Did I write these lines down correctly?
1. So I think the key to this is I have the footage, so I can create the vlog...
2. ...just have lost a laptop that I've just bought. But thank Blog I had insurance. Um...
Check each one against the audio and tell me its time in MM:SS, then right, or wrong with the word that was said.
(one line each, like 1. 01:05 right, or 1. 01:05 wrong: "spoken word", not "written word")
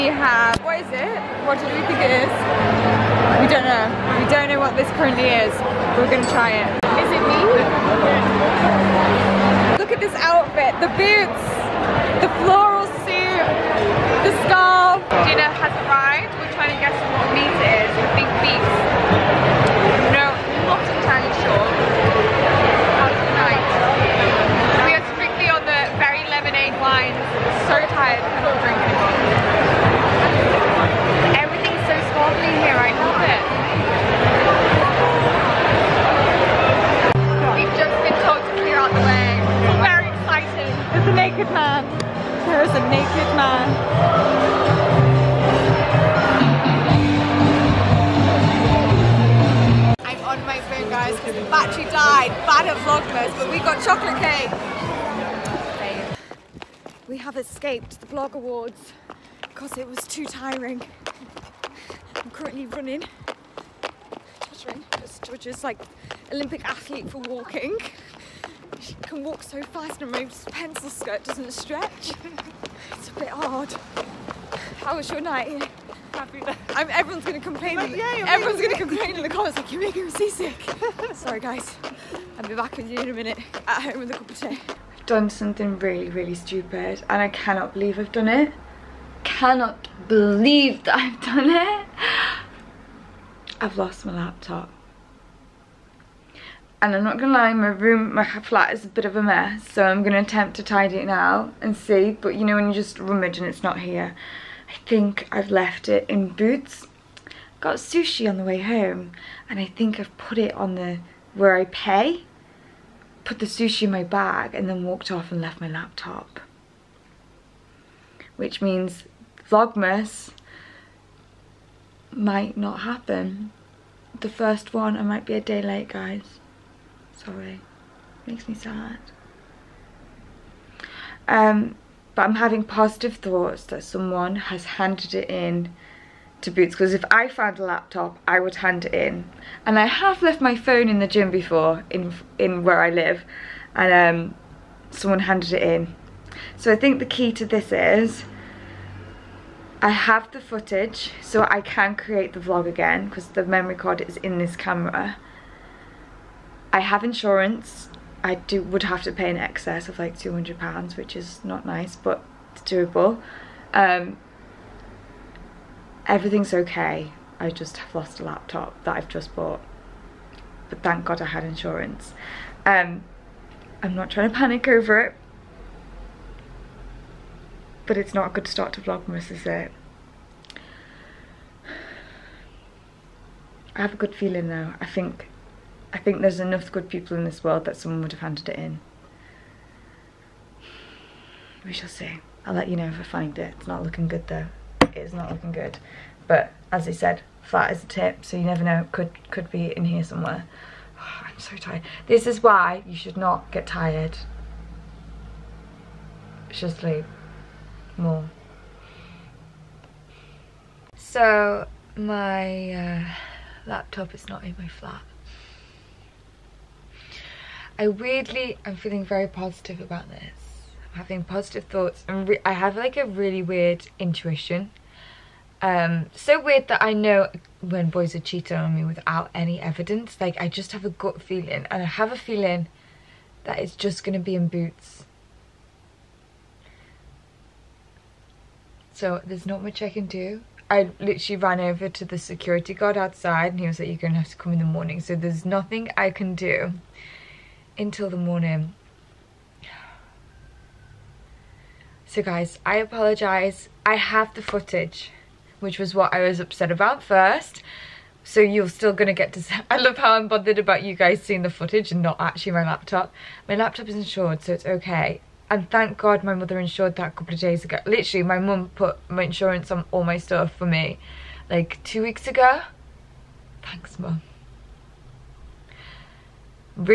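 1. 02:26 right
2. 02:47 wrong: "God", not "Blog".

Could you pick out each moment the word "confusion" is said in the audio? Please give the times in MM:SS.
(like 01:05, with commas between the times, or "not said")
not said.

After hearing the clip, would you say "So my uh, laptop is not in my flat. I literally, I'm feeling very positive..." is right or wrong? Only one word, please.
wrong.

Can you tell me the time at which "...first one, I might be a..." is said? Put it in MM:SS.
02:04.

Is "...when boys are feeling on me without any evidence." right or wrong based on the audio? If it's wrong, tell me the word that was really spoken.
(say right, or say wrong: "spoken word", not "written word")
wrong: "cheating", not "feeling".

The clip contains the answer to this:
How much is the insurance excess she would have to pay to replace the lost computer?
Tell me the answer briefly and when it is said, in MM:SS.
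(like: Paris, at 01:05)
£200, at 02:40.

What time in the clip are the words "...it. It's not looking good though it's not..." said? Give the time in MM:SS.
03:13.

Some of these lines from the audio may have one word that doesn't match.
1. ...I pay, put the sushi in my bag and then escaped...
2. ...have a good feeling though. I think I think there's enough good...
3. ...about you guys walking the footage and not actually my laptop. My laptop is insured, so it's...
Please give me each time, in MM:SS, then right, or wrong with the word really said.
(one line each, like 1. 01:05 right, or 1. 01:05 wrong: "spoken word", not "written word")
1. 01:51 wrong: "walked", not "escaped"
2. 03:03 right
3. 04:20 wrong: "seeing", not "walking".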